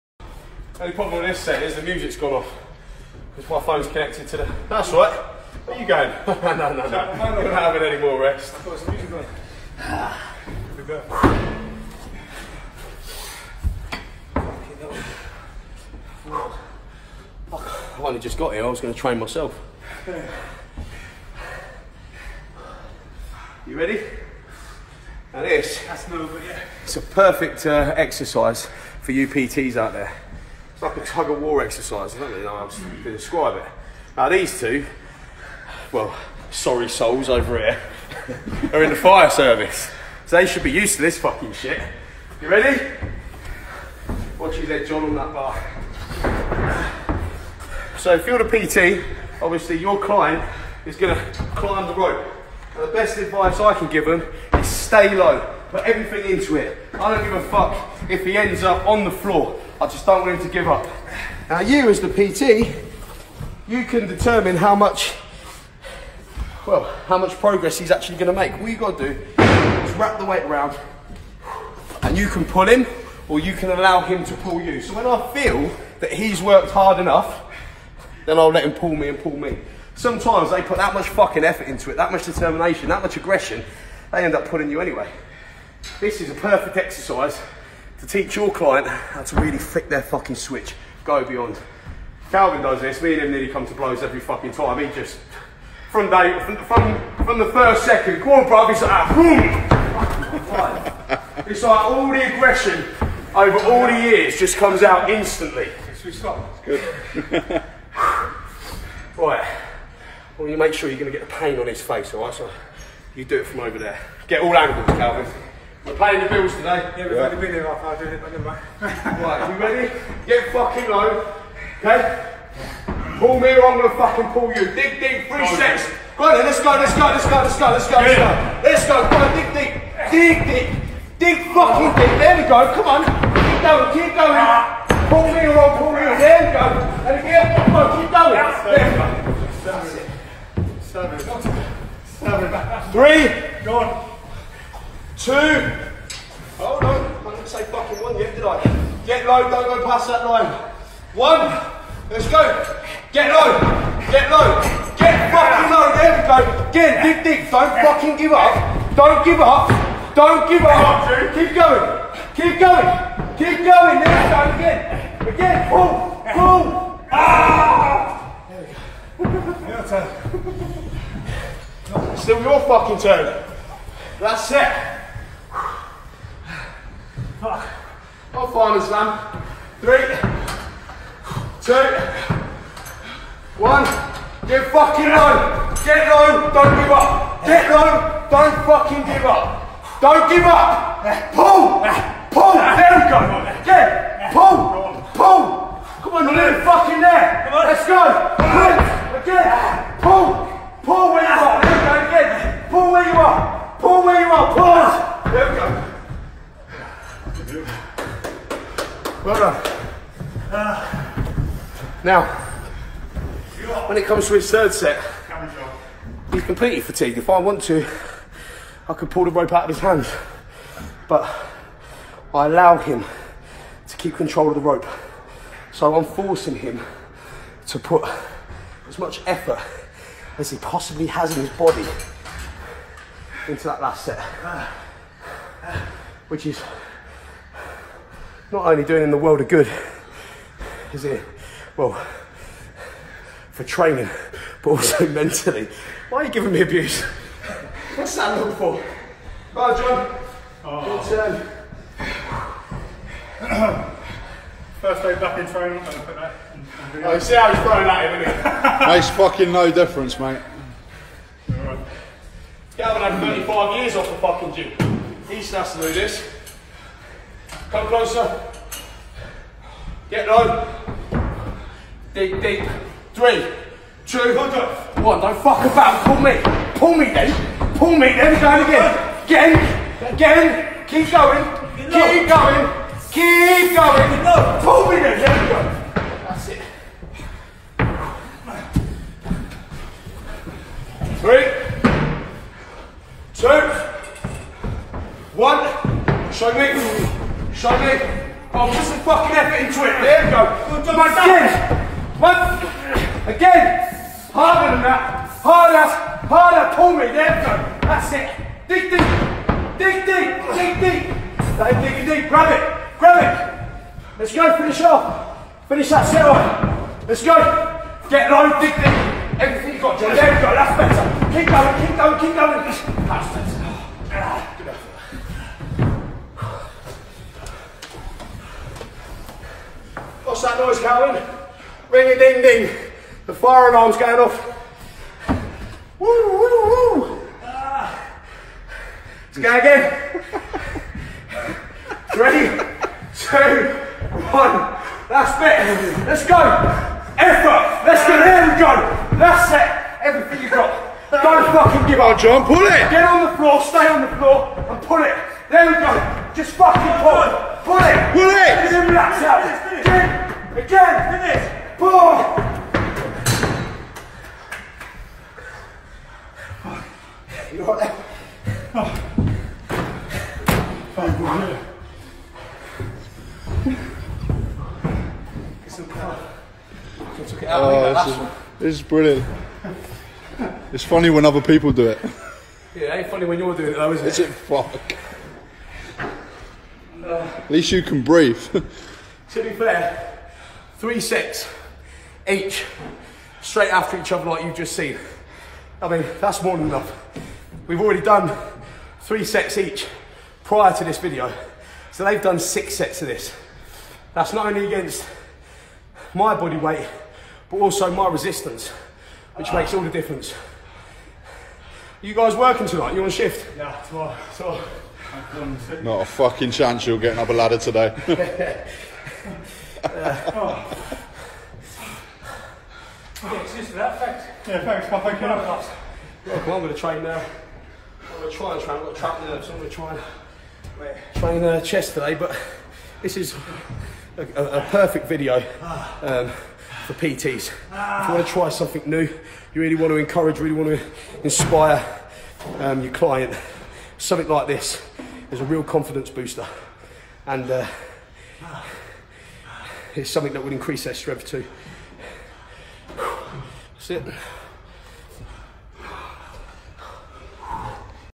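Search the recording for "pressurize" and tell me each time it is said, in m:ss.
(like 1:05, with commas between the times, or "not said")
not said.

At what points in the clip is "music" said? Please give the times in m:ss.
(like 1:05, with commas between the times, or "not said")
0:01, 0:08.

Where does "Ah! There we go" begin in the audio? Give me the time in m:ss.
2:47.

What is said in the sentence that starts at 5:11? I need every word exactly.
Dave, dig deep, grab it, grab it.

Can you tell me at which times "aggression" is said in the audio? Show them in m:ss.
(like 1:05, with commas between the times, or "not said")
1:23, 1:42.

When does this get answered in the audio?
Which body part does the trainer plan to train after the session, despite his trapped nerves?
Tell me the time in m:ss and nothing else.
7:11.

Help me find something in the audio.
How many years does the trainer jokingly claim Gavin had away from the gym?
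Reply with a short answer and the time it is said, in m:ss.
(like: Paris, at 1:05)
35, at 4:23.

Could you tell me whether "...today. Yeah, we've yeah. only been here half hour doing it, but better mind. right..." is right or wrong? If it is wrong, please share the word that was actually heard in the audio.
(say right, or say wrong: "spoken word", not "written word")
wrong: "never", not "better".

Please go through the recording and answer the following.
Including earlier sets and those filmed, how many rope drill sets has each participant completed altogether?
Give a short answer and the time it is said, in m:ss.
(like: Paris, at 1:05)
6, at 6:42.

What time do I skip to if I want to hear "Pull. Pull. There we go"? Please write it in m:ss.
3:11.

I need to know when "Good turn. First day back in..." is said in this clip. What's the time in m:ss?
4:10.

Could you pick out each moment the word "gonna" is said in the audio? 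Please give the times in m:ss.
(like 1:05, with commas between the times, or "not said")
1:08, 2:03, 7:09.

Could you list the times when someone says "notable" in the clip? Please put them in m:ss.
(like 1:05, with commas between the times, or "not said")
not said.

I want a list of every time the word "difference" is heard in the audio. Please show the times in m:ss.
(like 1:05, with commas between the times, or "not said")
4:19, 6:49.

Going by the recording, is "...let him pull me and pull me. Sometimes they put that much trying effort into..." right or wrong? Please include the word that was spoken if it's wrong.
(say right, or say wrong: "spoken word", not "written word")
wrong: "fucking", not "trying".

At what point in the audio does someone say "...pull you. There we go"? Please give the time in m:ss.
2:15.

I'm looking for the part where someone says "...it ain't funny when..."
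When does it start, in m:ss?
6:22.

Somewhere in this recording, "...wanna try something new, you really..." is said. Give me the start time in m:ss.
7:18.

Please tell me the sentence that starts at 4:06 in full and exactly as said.
Why are you giving me abuse?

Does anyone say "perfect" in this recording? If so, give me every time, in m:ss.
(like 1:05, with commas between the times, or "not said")
0:27, 1:26, 7:14.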